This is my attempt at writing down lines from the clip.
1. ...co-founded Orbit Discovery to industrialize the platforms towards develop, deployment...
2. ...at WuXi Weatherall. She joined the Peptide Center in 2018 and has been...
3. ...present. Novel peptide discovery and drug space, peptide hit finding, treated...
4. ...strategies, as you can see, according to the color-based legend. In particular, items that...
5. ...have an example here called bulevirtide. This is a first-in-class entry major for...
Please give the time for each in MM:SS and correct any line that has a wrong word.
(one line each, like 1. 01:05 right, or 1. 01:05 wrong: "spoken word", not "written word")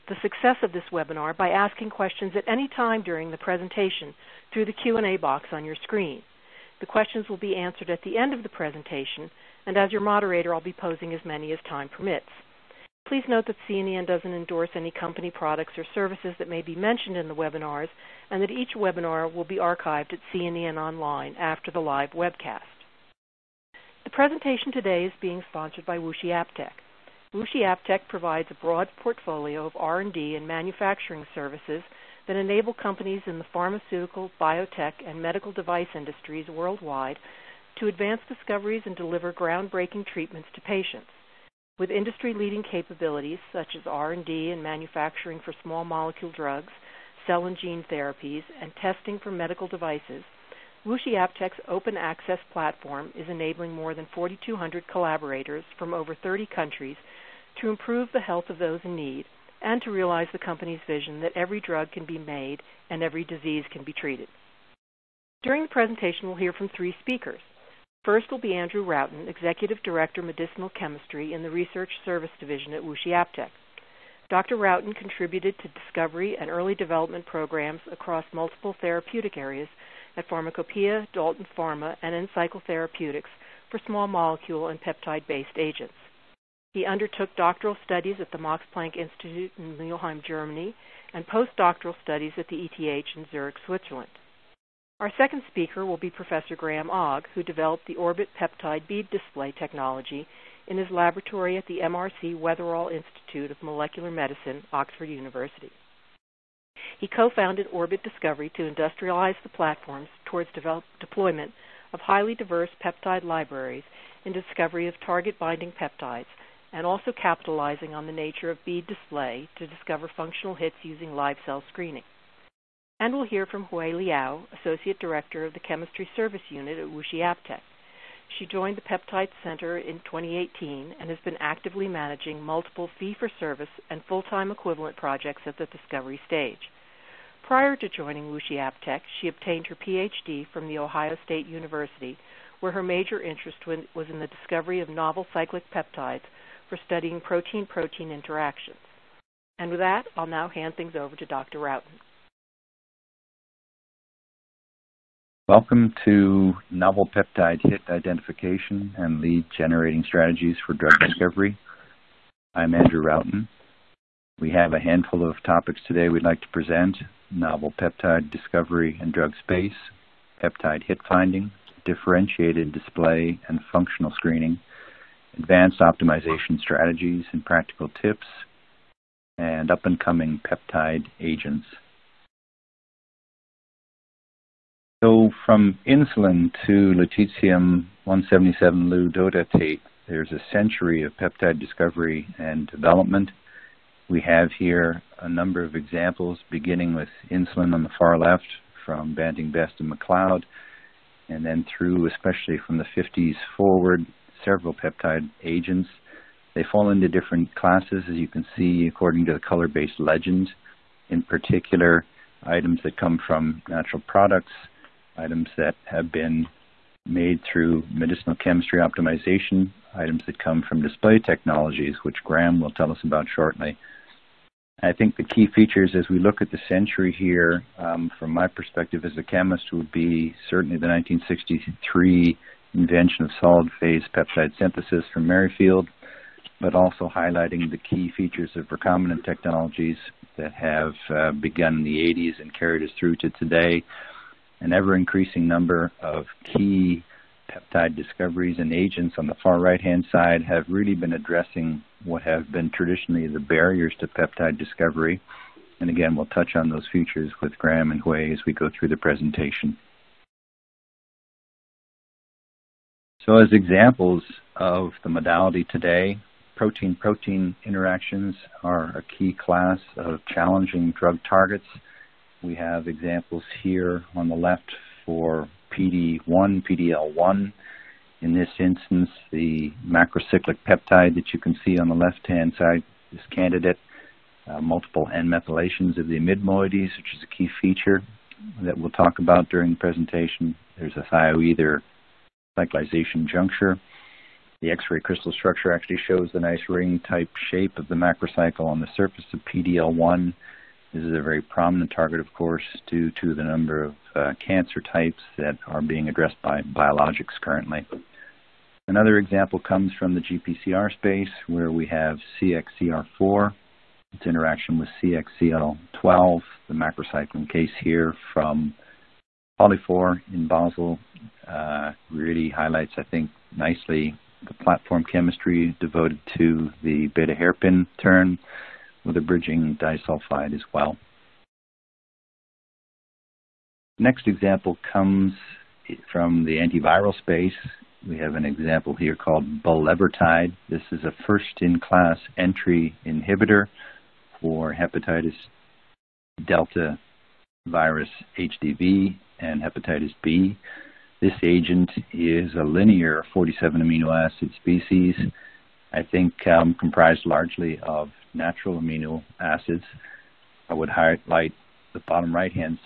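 1. 01:47 right
2. 02:06 wrong: "AppTech", not "Weatherall"
3. 02:46 wrong: "differentiated", not "treated"
4. 03:27 wrong: "classes", not "strategies"
5. 05:38 wrong: "inhibitor", not "major".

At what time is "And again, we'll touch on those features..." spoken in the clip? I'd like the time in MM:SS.
04:15.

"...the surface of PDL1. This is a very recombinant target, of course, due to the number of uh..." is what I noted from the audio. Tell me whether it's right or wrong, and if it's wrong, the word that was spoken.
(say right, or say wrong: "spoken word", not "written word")
wrong: "prominent", not "recombinant".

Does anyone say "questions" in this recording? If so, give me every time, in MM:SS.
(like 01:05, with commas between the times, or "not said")
00:01, 00:06.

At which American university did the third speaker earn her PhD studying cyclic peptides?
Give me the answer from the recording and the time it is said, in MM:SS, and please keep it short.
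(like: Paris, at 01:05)
The Ohio State University, at 02:20.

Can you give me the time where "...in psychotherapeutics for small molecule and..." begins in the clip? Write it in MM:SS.
01:22.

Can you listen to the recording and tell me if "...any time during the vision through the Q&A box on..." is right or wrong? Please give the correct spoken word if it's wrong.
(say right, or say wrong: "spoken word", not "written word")
wrong: "presentation", not "vision".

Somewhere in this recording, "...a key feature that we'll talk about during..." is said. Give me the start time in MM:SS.
04:47.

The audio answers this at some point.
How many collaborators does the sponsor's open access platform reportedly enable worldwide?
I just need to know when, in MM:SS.
00:53.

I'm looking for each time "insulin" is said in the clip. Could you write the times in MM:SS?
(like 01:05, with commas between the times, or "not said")
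03:05, 03:17.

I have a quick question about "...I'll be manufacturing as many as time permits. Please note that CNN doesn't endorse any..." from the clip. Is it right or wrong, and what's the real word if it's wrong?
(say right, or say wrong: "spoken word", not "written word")
wrong: "posing", not "manufacturing".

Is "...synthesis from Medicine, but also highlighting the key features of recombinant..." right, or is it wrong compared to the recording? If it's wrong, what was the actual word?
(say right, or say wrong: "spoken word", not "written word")
wrong: "Merrifield", not "Medicine".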